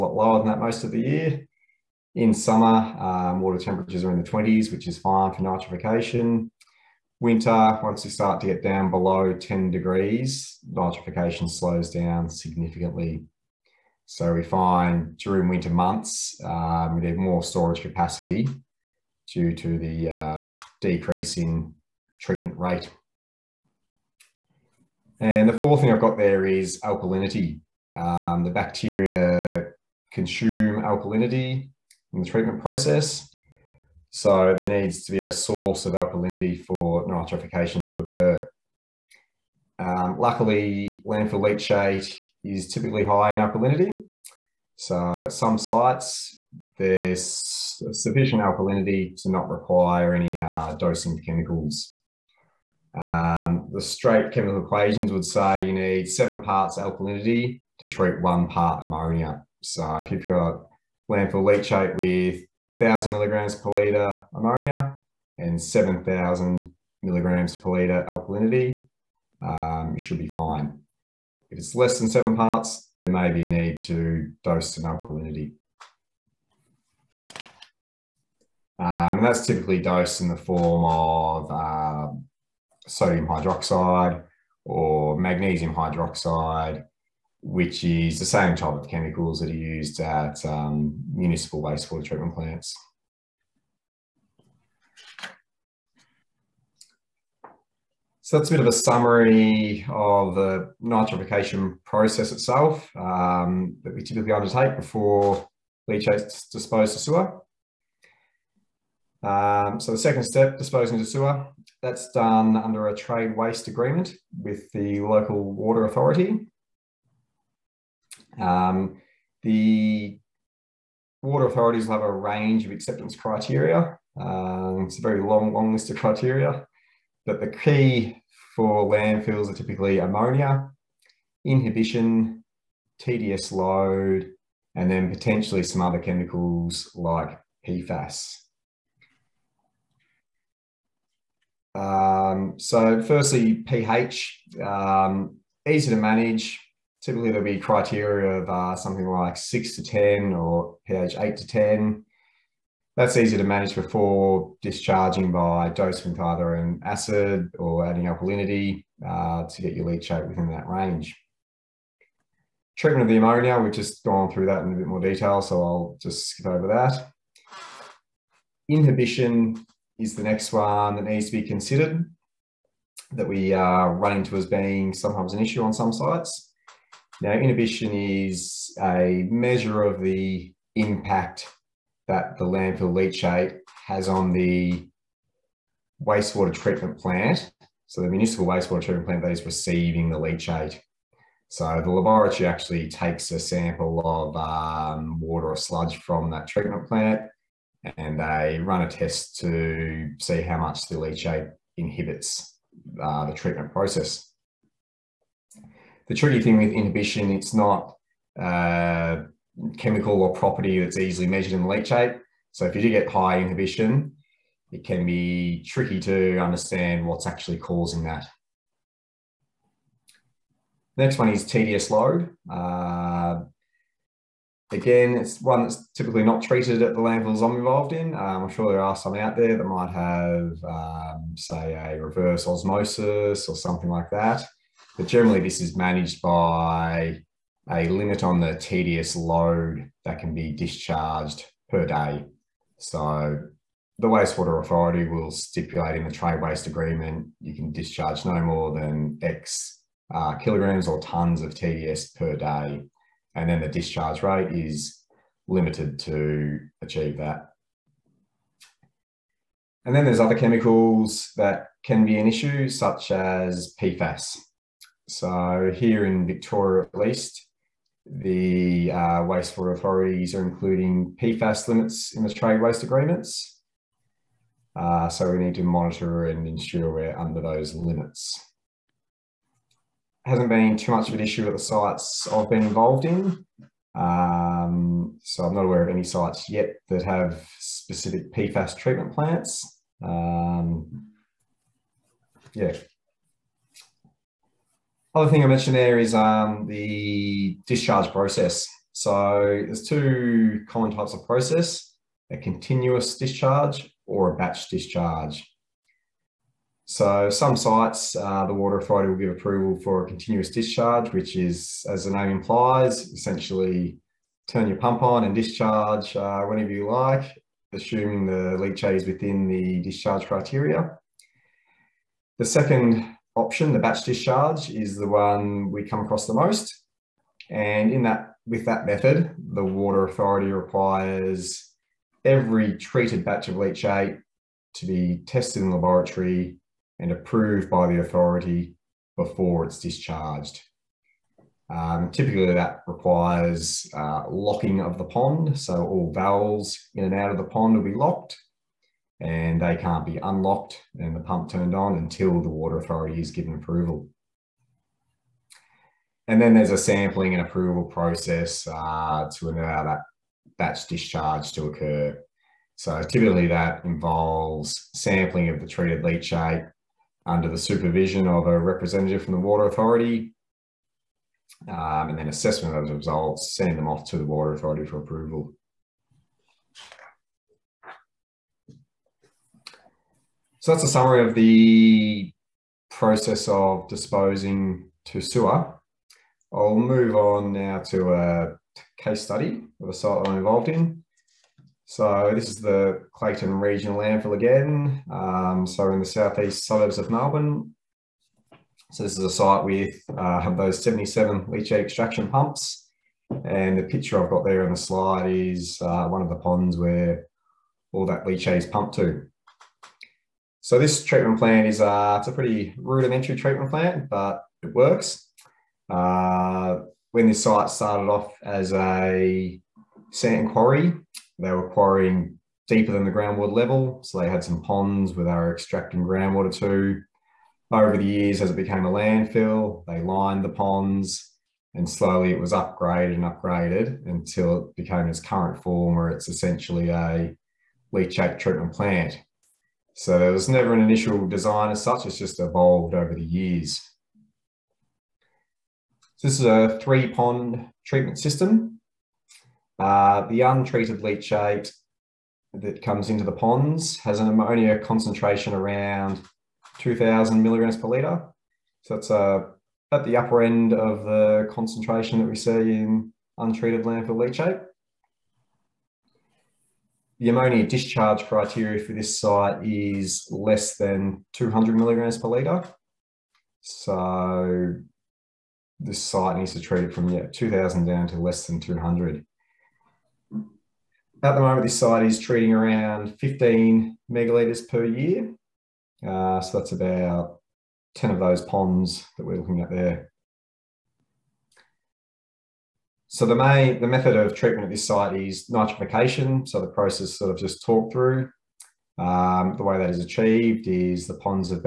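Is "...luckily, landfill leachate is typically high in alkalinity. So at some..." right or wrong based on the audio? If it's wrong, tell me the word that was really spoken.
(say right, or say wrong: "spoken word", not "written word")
right.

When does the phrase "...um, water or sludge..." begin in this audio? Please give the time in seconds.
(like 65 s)
194 s.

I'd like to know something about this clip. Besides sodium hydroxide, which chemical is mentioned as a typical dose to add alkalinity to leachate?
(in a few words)
magnesium hydroxide.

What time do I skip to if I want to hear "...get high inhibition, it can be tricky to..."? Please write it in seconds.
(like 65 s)
212 s.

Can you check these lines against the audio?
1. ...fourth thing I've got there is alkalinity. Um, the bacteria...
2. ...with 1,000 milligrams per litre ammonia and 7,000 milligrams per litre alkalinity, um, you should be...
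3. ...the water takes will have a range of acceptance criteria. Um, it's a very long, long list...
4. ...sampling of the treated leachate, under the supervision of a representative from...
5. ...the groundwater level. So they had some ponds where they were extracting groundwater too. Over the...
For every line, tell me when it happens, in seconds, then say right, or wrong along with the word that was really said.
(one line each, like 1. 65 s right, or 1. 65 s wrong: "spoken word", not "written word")
1. 25 s right
2. 61 s right
3. 119 s wrong: "authorities", not "takes"
4. 364 s right
5. 423 s right.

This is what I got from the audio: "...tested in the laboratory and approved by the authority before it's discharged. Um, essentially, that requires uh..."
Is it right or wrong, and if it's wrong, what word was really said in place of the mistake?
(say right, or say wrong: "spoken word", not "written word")
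wrong: "typically", not "essentially".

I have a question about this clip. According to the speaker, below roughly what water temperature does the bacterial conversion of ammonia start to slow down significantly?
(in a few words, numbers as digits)
10 degrees.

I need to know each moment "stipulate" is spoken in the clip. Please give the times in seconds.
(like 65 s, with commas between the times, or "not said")
245 s.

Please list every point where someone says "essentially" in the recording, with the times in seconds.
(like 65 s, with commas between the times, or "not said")
313 s, 436 s.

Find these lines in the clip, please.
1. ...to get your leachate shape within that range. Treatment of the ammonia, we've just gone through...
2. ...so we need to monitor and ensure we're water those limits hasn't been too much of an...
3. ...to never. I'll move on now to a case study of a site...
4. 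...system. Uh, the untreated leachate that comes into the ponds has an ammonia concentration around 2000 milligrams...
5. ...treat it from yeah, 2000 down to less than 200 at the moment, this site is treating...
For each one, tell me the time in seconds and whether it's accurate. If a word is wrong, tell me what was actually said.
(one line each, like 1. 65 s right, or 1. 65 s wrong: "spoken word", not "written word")
1. 159 s right
2. 275 s wrong: "under", not "water"
3. 385 s wrong: "sewer", not "never"
4. 448 s right
5. 476 s right.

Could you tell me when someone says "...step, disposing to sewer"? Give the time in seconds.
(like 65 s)
110 s.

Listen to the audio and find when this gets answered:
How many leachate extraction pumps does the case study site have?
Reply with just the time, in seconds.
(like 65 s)
400 s.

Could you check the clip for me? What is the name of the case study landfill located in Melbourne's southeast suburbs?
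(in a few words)
Clayton Regional Landfill.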